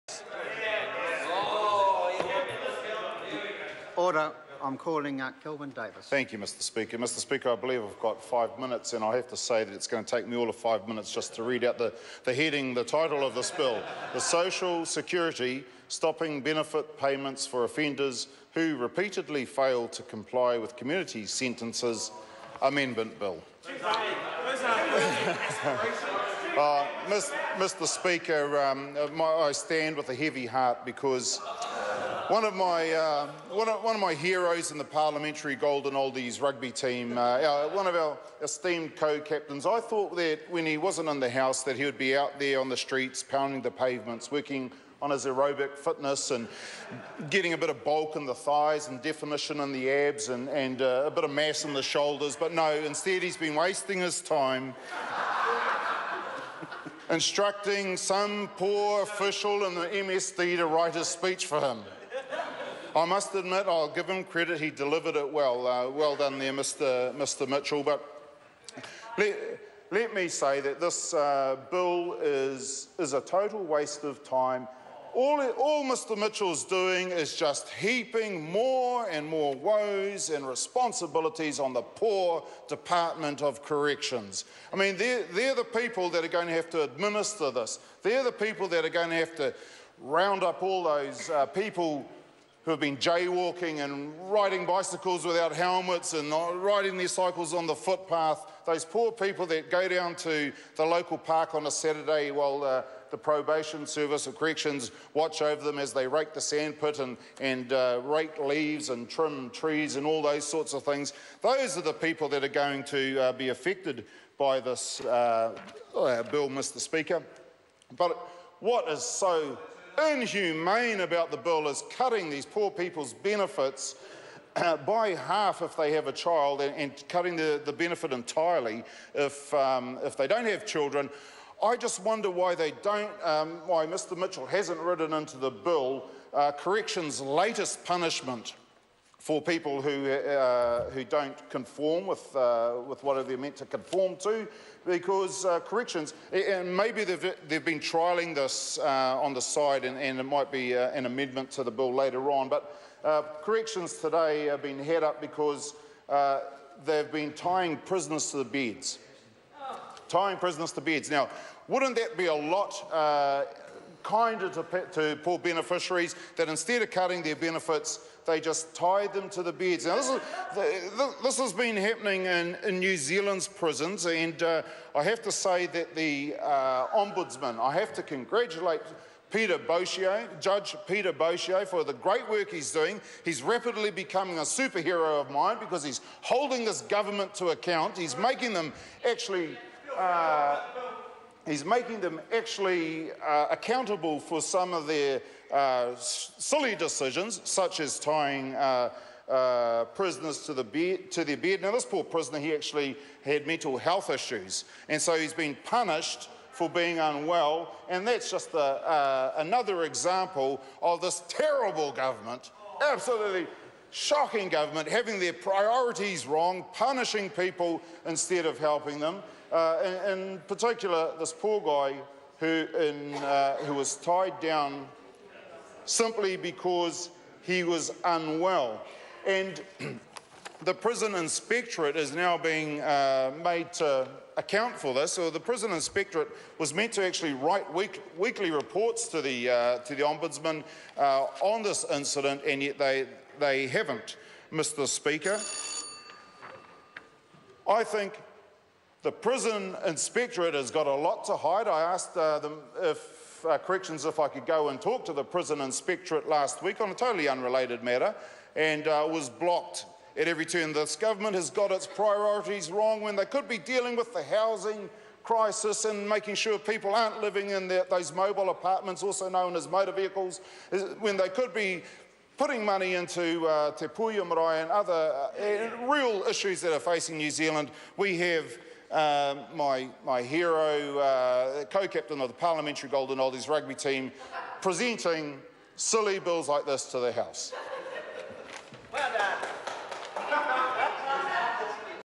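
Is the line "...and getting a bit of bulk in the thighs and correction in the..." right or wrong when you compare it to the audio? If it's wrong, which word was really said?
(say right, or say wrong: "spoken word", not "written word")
wrong: "definition", not "correction".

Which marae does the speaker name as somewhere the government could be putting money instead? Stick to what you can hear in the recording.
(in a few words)
Te Puea Marae.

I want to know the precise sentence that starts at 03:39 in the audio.
Uh, in, in, particular, this poor guy who, in, uh, who was tied down simply because he was unwell.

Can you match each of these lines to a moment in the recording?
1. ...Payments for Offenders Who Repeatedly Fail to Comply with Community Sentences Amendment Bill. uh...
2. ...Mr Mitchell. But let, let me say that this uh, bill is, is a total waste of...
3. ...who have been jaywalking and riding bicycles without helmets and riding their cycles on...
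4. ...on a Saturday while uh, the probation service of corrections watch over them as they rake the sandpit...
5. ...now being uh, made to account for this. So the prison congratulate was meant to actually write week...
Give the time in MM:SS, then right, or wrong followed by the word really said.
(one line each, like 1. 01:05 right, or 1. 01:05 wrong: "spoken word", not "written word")
1. 00:16 right
2. 01:07 right
3. 01:32 right
4. 01:41 right
5. 03:52 wrong: "inspectorate", not "congratulate".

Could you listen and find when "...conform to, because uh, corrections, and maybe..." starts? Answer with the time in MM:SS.
02:23.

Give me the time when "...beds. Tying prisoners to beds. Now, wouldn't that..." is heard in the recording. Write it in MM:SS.
02:38.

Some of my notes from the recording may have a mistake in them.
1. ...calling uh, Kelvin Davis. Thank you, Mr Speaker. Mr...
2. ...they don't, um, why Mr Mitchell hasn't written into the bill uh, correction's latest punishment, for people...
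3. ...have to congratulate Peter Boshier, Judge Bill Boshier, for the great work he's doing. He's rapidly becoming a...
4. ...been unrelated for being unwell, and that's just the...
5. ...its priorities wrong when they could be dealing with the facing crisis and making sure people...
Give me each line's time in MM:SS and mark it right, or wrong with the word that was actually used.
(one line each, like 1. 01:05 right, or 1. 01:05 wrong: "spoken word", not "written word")
1. 00:04 right
2. 02:12 right
3. 02:57 wrong: "Peter", not "Bill"
4. 03:25 wrong: "punished", not "unrelated"
5. 04:21 wrong: "housing", not "facing".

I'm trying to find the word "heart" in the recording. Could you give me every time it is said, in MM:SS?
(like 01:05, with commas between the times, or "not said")
00:30.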